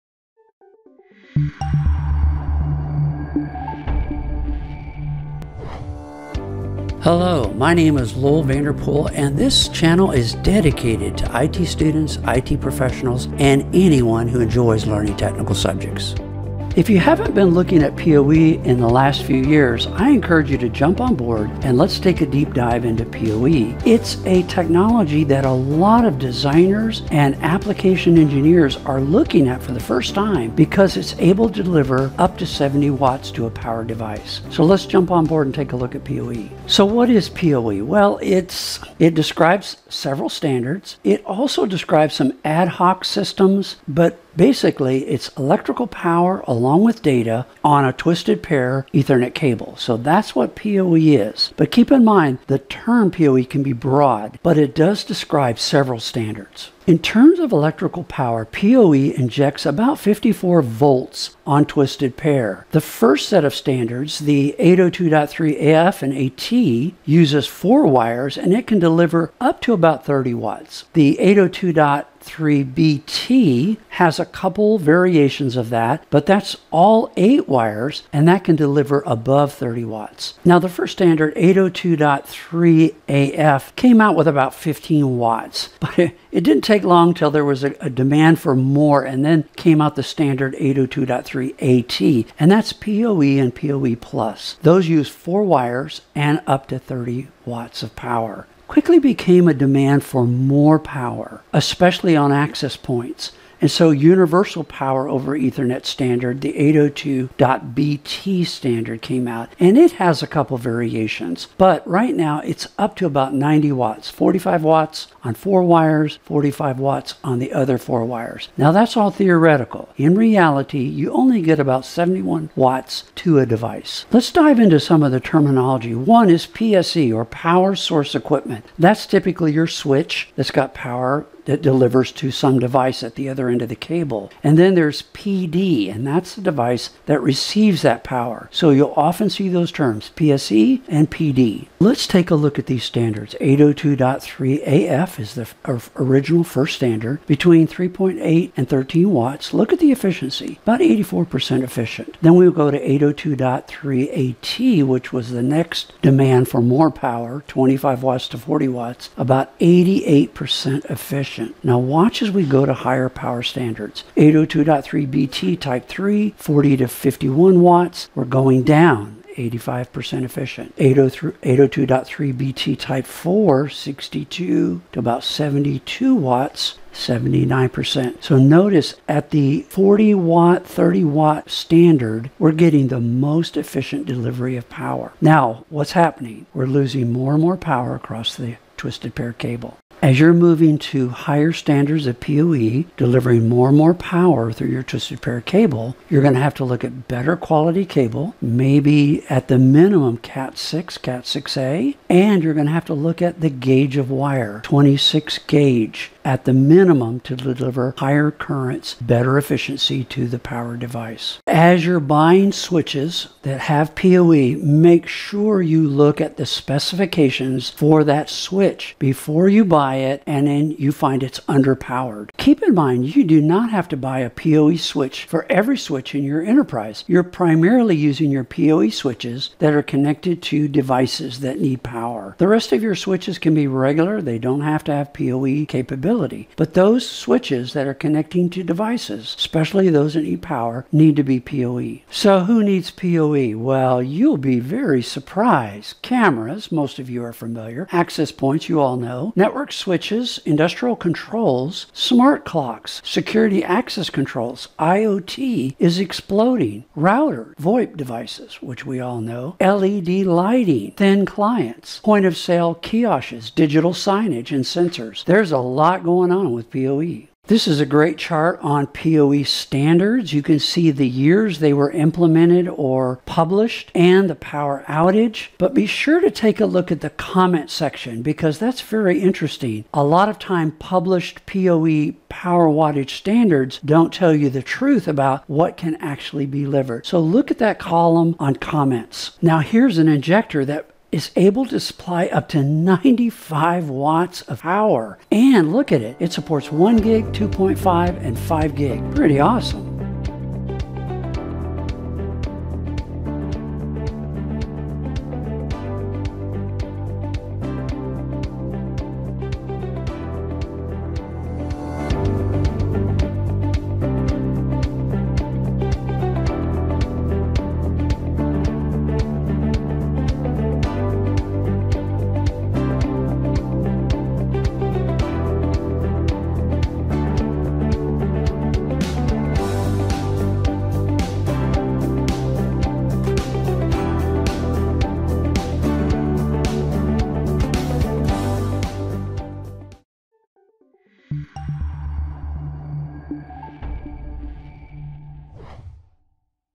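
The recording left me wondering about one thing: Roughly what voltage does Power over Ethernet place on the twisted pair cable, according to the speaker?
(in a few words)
54 volts.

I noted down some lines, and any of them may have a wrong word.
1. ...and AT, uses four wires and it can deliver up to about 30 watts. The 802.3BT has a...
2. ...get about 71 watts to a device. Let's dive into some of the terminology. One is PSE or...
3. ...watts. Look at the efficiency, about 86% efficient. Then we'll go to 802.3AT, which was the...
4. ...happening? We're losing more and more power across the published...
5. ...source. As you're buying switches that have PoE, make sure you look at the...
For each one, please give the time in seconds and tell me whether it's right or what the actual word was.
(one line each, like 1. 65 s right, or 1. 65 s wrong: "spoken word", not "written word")
1. 66 s right
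2. 121 s right
3. 149 s wrong: "84", not "86"
4. 185 s wrong: "twisted", not "published"
5. 210 s wrong: "device", not "source".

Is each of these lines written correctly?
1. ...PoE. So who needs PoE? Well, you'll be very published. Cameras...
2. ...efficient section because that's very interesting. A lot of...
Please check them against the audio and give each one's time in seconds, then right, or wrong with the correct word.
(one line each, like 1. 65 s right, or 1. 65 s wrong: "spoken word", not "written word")
1. 241 s wrong: "surprised", not "published"
2. 277 s wrong: "comment", not "efficient".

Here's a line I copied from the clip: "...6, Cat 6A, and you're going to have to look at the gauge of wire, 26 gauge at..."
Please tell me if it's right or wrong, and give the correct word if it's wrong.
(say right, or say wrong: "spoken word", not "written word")
right.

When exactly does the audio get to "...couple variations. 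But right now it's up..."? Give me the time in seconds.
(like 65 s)
110 s.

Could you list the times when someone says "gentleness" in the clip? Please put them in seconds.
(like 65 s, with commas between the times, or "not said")
not said.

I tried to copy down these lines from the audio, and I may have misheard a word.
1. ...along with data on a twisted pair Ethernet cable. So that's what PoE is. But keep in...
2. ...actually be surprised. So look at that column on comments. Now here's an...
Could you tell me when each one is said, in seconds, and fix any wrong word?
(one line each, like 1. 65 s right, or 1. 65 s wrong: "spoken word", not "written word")
1. 46 s right
2. 285 s wrong: "delivered", not "surprised".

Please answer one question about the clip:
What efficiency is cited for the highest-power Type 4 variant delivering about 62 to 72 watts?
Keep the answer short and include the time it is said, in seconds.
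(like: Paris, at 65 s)
79%, at 176 s.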